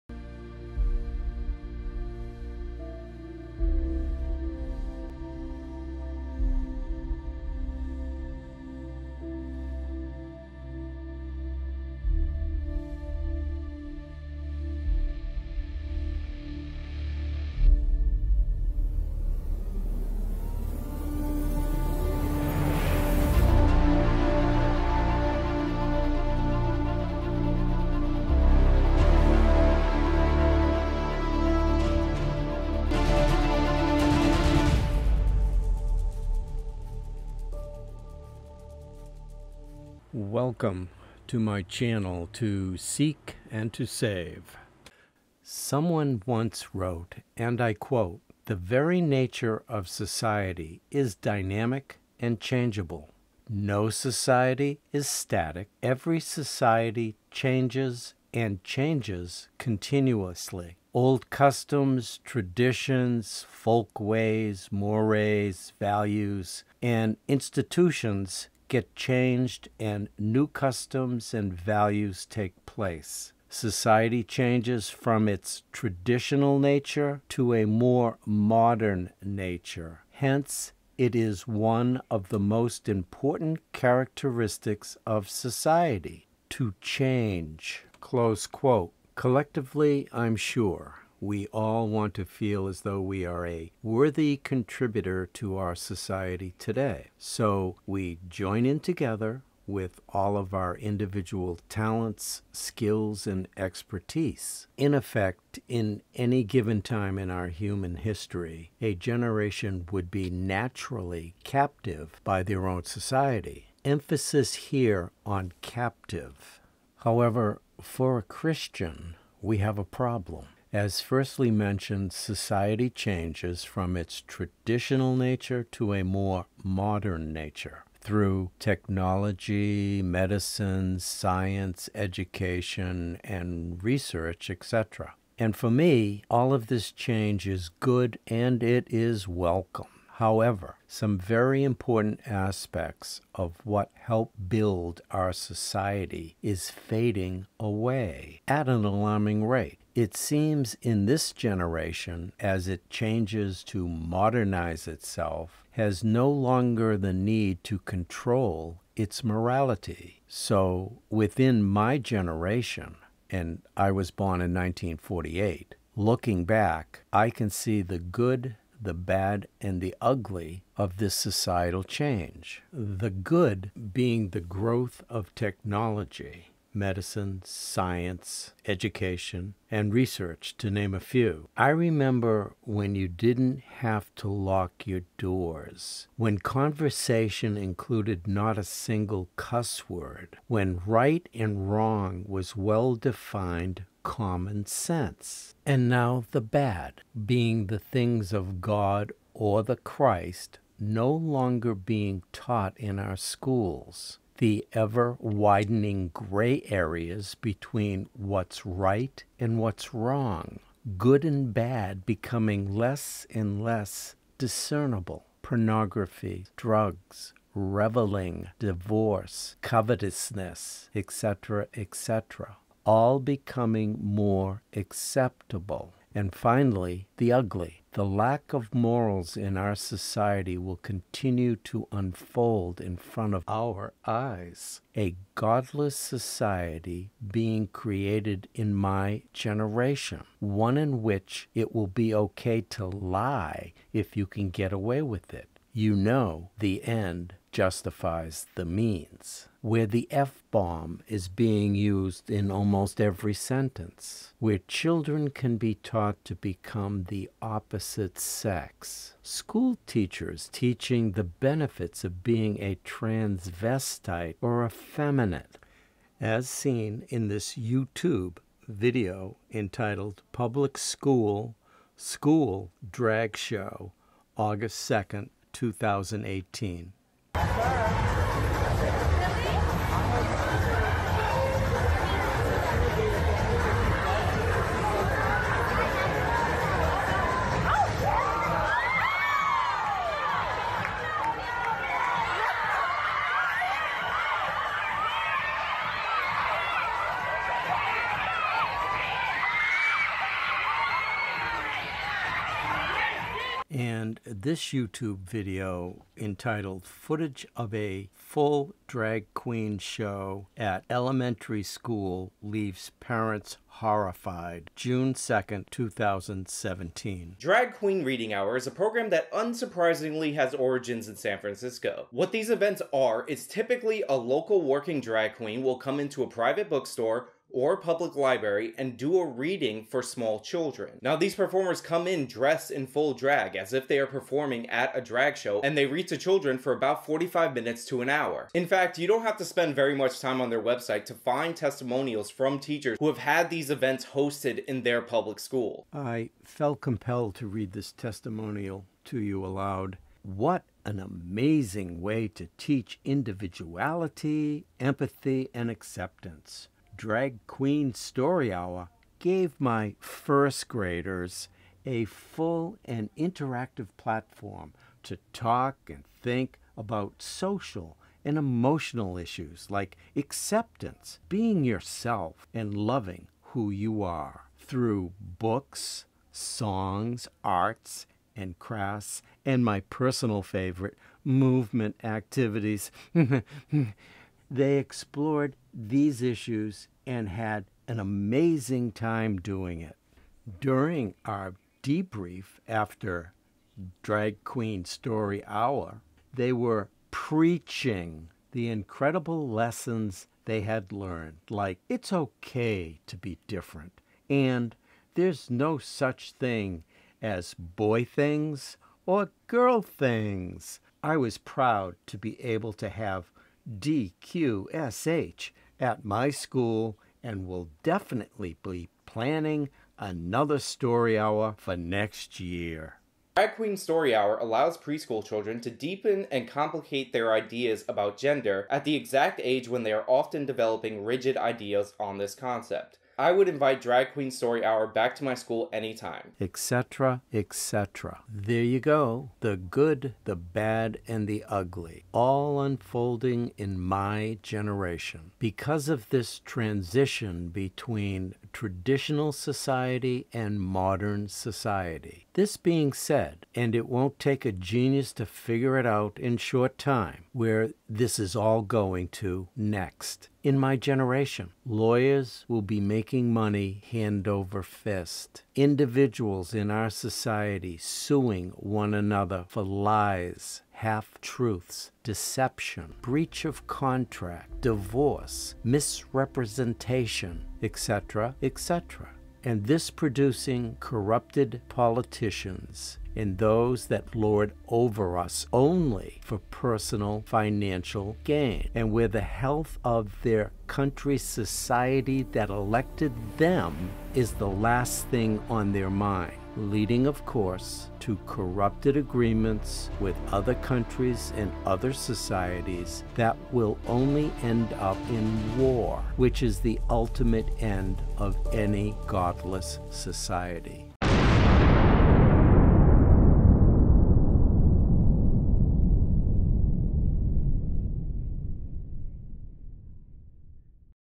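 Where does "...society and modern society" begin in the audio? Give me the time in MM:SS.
07:29.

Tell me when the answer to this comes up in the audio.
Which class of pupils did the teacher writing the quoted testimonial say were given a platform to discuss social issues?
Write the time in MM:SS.
05:59.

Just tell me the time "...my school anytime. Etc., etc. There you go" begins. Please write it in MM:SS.
07:15.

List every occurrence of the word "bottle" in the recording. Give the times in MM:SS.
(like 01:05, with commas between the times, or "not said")
not said.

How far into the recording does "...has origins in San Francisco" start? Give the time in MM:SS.
05:20.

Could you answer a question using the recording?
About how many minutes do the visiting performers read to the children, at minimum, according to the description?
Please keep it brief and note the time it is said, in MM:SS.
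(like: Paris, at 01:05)
45 minutes, at 05:37.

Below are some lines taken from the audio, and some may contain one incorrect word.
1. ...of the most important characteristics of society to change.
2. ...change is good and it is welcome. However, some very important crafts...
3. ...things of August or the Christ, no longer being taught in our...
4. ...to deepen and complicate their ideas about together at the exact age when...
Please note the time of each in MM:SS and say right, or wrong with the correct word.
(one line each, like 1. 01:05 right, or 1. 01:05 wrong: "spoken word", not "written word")
1. 01:22 right
2. 02:16 wrong: "aspects", not "crafts"
3. 03:17 wrong: "God", not "August"
4. 07:05 wrong: "gender", not "together".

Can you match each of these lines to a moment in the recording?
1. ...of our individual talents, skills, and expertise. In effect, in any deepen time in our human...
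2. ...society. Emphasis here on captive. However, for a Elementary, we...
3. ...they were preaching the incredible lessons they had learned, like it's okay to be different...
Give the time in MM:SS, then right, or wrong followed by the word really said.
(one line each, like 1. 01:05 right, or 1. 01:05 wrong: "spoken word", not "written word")
1. 01:40 wrong: "given", not "deepen"
2. 01:52 wrong: "Christian", not "Elementary"
3. 06:36 right.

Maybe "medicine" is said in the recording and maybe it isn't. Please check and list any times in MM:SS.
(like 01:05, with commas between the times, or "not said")
02:10, 02:56.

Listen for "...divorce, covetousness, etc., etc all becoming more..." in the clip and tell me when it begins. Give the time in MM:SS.
03:38.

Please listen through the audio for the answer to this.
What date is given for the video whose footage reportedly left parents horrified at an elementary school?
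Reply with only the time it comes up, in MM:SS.
05:14.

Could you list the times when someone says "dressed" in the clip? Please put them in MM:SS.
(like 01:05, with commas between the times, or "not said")
05:32.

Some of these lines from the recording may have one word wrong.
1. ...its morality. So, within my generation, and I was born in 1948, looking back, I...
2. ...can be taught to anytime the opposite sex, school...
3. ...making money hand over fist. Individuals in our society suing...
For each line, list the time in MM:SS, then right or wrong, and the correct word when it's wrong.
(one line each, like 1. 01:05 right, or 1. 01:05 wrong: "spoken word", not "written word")
1. 02:38 right
2. 04:15 wrong: "become", not "anytime"
3. 07:42 right.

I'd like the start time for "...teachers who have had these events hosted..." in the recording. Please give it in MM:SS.
05:42.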